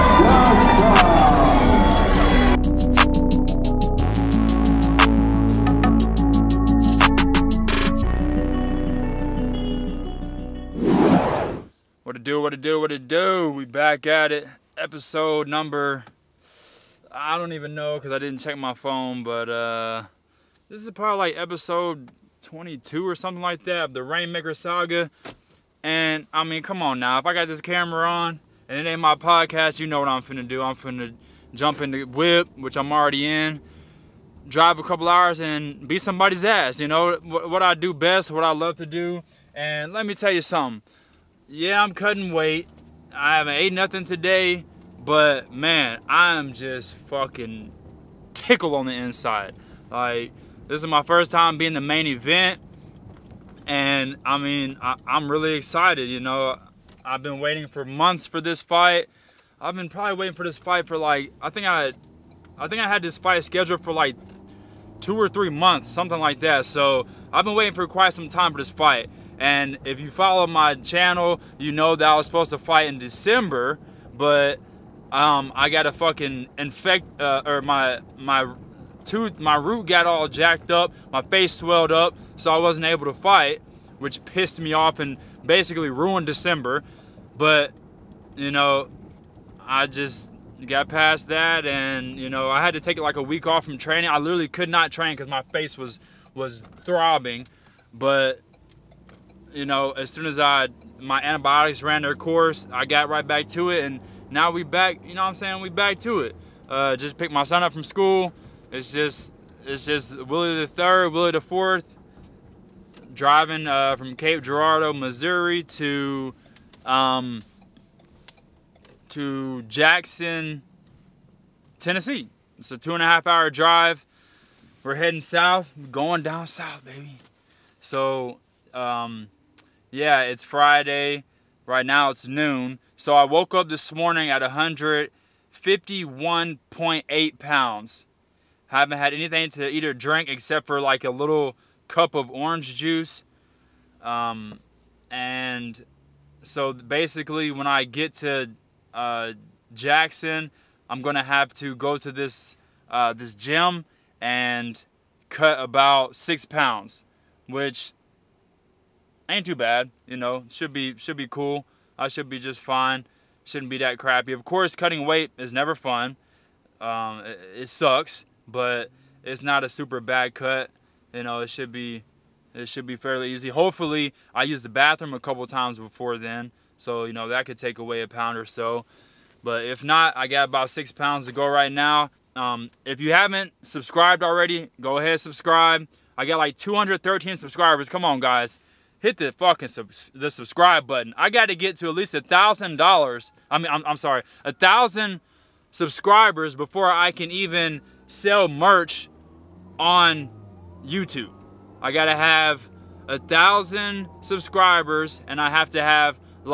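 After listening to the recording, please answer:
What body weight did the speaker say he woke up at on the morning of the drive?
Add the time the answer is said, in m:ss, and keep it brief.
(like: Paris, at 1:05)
151.8 pounds, at 2:14.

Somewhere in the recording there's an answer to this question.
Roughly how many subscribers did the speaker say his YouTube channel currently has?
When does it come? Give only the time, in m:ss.
3:06.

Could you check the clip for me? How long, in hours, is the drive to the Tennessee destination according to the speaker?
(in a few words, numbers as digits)
2.5 hours.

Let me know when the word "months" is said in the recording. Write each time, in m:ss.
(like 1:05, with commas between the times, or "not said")
0:57, 1:05.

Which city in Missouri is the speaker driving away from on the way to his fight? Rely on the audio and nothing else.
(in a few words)
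Cape Girardeau.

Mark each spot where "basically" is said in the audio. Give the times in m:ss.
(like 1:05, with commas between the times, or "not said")
1:25, 2:26.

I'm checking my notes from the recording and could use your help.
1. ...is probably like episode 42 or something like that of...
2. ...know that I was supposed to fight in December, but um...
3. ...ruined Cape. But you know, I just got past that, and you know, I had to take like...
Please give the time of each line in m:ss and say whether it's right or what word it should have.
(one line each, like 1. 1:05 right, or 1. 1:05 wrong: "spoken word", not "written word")
1. 0:20 wrong: "22", not "42"
2. 1:11 right
3. 1:25 wrong: "December", not "Cape".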